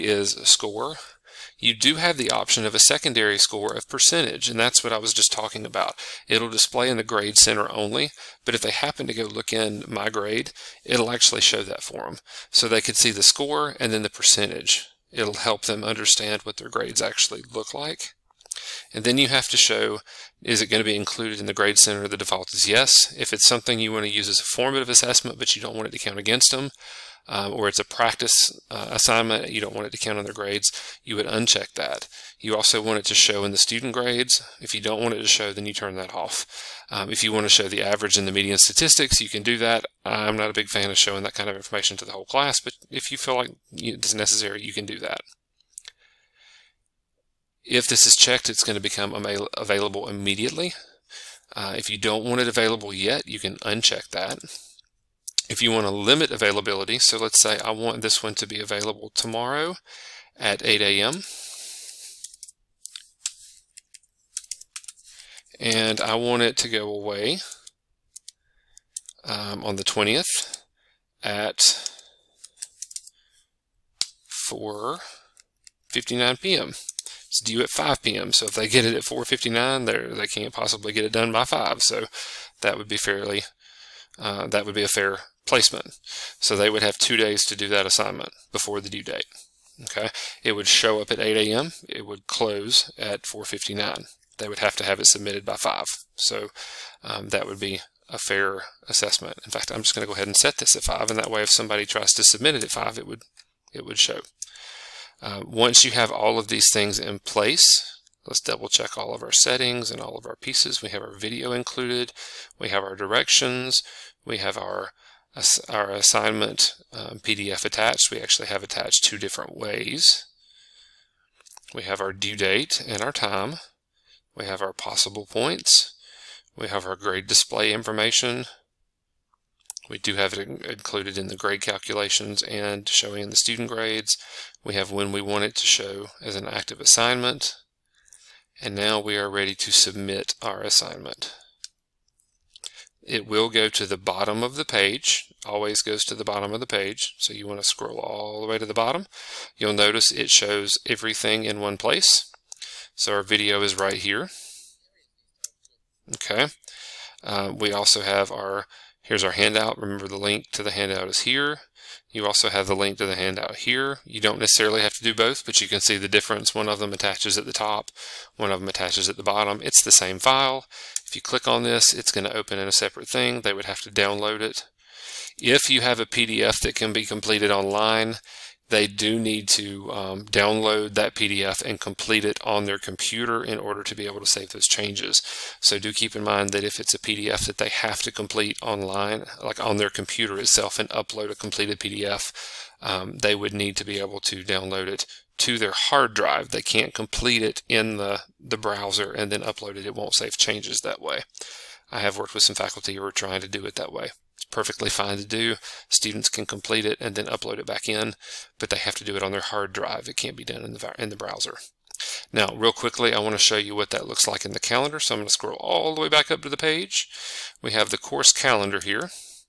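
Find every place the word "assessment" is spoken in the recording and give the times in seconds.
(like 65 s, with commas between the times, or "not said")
24 s, 98 s.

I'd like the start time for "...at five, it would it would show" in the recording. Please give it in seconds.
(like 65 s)
102 s.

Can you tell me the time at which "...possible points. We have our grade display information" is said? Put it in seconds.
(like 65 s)
124 s.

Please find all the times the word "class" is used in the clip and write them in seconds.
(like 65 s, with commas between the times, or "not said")
42 s.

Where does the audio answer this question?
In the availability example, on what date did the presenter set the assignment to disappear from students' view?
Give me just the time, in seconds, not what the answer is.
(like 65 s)
69 s.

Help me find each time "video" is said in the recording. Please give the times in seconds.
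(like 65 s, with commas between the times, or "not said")
111 s, 153 s.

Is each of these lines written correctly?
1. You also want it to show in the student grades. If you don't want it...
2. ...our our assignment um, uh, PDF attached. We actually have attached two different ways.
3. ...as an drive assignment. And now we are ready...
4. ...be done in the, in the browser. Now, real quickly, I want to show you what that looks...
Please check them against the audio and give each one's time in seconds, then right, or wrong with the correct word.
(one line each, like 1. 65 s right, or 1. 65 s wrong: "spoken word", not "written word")
1. 32 s right
2. 114 s right
3. 136 s wrong: "active", not "drive"
4. 210 s right.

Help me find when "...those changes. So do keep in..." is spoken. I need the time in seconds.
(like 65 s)
184 s.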